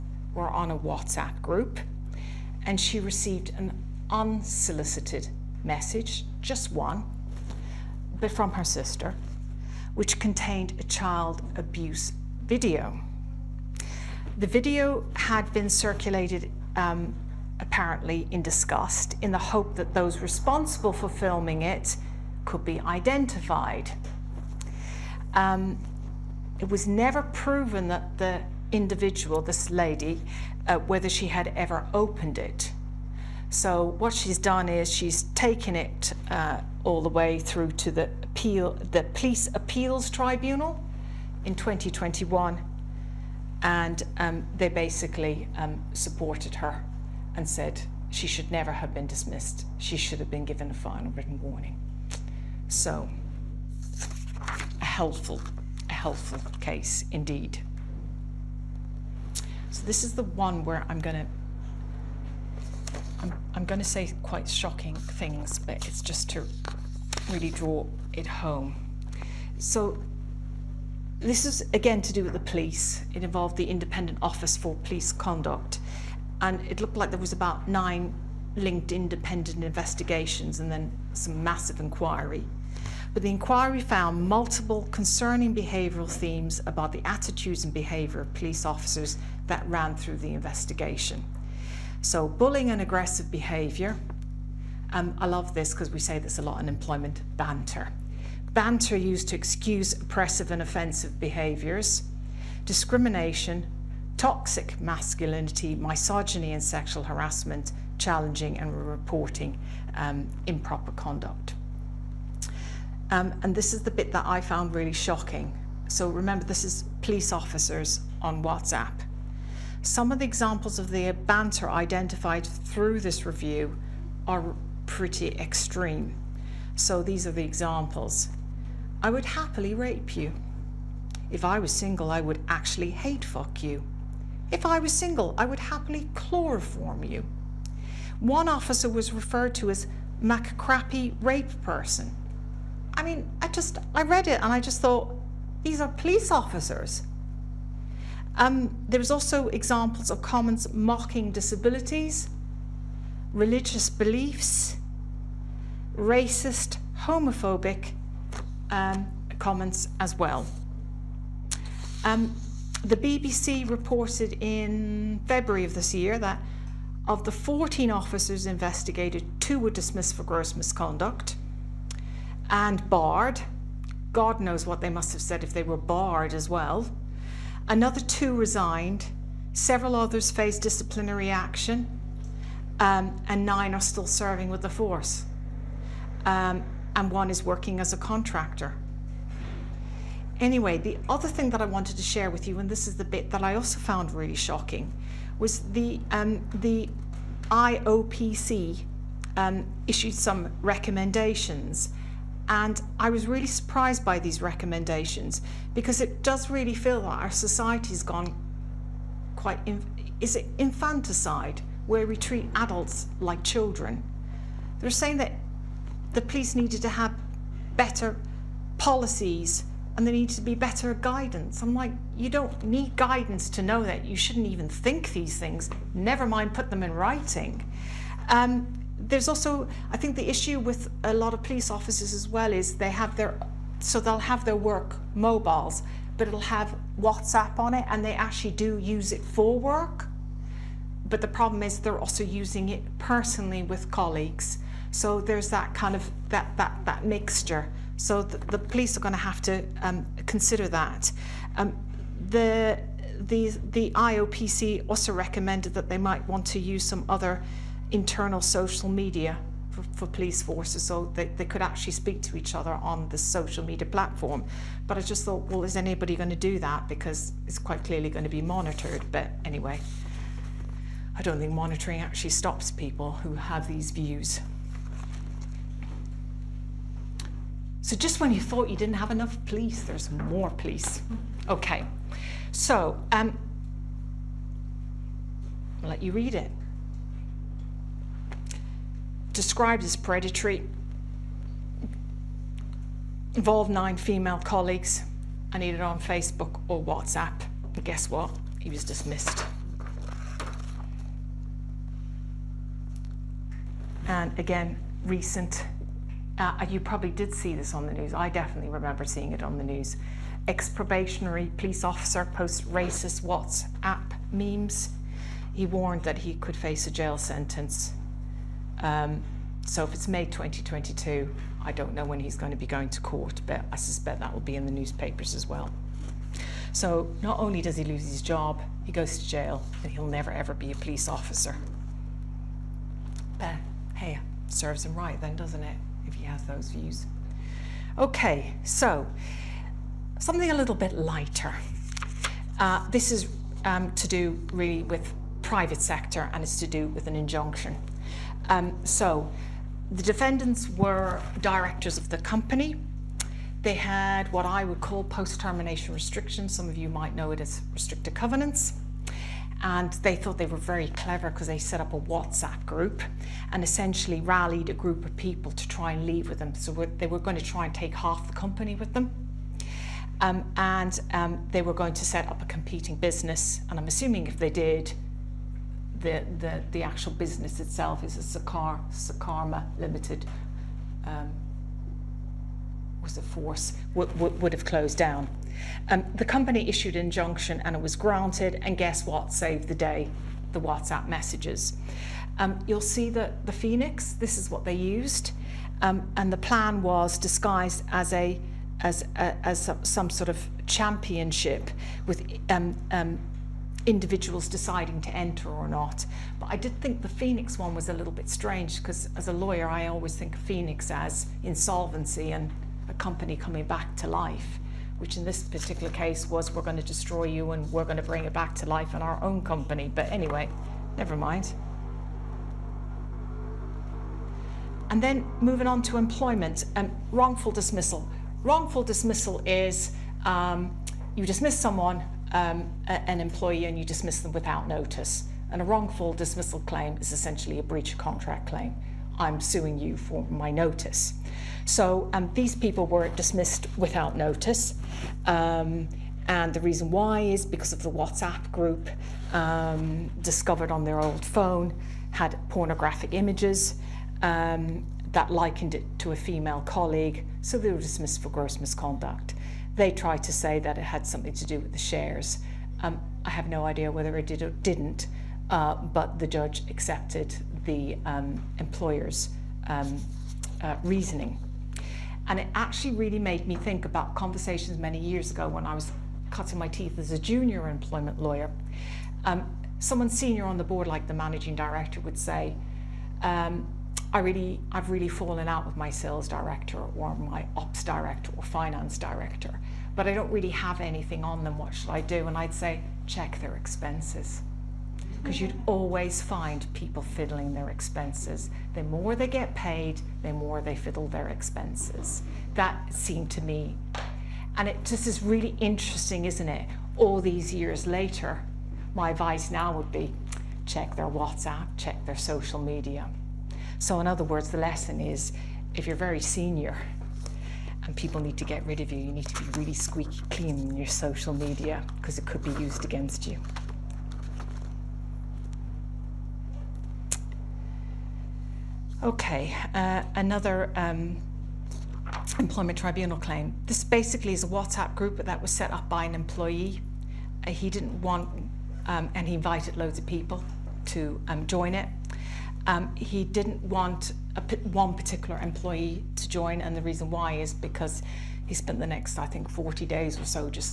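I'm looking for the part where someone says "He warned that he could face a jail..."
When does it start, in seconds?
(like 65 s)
315 s.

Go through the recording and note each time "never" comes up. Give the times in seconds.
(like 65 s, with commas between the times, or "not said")
26 s, 48 s, 225 s, 330 s, 420 s.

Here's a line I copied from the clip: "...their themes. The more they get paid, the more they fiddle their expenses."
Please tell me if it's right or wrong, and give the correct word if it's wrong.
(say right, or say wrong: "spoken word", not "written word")
wrong: "expenses", not "themes".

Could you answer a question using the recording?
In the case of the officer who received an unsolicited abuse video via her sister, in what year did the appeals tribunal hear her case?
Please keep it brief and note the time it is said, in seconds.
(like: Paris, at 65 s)
2021, at 41 s.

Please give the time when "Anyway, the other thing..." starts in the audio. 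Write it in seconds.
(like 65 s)
190 s.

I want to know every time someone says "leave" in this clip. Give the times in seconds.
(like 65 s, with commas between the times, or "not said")
366 s.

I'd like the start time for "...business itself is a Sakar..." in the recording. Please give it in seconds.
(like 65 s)
377 s.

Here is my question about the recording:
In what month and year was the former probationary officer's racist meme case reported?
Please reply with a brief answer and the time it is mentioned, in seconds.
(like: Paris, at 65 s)
May 2022, at 320 s.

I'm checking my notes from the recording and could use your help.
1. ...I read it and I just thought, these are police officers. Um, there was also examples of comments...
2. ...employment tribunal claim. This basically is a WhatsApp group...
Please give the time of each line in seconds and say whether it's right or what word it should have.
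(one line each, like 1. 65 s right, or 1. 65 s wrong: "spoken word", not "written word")
1. 143 s right
2. 532 s right.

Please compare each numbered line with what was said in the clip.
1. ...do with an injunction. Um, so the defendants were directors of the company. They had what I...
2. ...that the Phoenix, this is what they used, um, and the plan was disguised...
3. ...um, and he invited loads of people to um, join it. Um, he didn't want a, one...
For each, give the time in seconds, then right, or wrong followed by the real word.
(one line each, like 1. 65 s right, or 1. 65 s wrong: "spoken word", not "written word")
1. 346 s right
2. 393 s right
3. 538 s right.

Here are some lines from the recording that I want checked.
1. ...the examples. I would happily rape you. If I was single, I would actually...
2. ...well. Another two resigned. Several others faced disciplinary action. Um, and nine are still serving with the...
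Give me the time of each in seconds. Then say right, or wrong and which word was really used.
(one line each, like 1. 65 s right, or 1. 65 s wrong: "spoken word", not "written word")
1. 127 s right
2. 176 s right.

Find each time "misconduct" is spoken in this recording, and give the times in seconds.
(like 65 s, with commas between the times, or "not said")
170 s, 458 s.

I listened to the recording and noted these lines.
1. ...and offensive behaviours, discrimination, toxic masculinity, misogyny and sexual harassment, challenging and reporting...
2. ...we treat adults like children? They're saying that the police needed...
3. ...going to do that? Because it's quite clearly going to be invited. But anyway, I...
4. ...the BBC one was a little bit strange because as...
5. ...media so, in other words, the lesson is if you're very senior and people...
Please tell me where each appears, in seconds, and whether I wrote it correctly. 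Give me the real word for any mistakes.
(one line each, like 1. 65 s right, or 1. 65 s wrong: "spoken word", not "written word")
1. 100 s right
2. 212 s right
3. 266 s wrong: "monitored", not "invited"
4. 407 s wrong: "Phoenix", not "BBC"
5. 512 s right.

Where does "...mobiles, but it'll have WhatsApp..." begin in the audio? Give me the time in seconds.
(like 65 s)
235 s.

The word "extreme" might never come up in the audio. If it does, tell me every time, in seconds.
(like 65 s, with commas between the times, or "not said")
125 s.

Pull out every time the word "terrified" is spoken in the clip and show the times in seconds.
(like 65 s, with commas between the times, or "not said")
not said.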